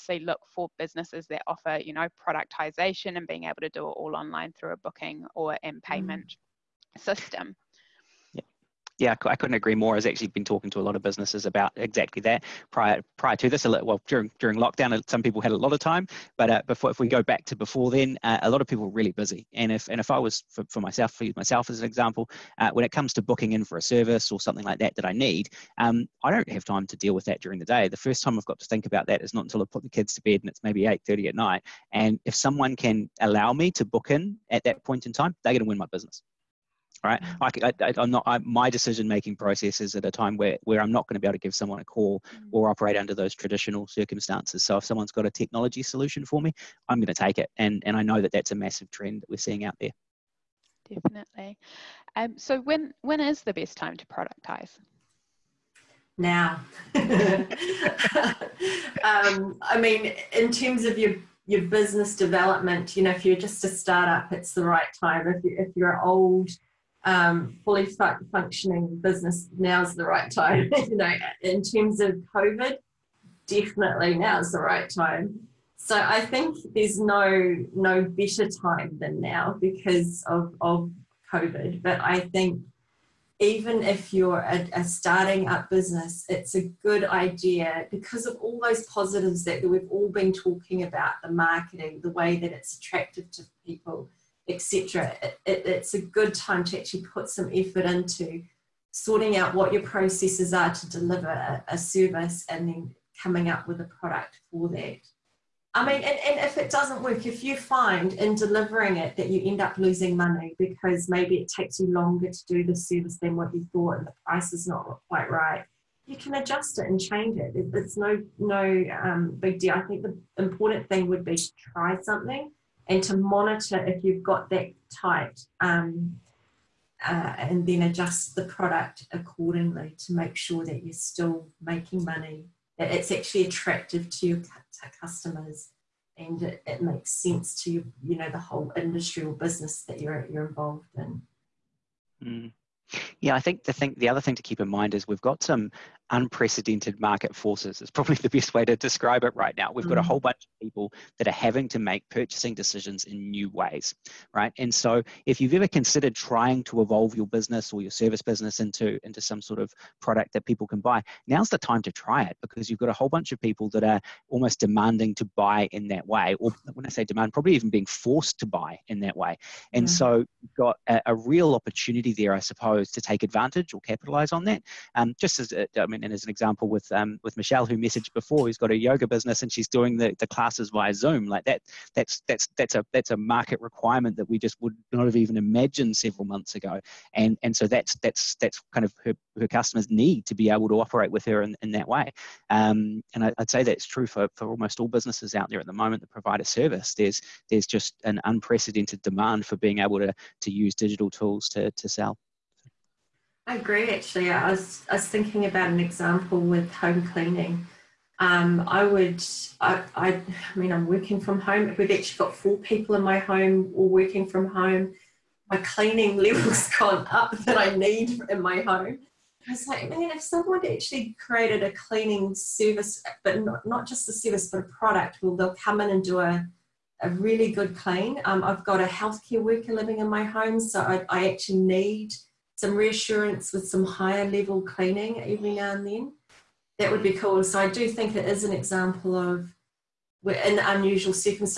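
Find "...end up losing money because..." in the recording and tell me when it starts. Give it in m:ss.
1:49.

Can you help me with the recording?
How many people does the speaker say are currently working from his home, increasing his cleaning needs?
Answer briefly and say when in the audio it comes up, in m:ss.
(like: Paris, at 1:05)
4, at 3:32.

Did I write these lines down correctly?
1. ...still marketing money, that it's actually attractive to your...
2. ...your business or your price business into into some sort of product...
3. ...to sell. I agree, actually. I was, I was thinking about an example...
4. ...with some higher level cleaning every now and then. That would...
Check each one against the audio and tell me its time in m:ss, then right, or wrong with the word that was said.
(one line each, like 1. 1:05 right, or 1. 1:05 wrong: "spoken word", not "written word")
1. 2:10 wrong: "making", not "marketing"
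2. 2:37 wrong: "service", not "price"
3. 3:21 right
4. 3:53 right.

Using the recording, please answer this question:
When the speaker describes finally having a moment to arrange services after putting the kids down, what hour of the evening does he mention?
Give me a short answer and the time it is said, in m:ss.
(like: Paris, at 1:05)
8:30, at 0:30.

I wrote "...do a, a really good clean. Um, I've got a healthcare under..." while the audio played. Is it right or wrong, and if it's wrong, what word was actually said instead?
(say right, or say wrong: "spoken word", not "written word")
wrong: "worker", not "under".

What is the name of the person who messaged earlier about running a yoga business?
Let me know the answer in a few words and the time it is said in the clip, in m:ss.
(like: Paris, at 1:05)
Michelle, at 2:57.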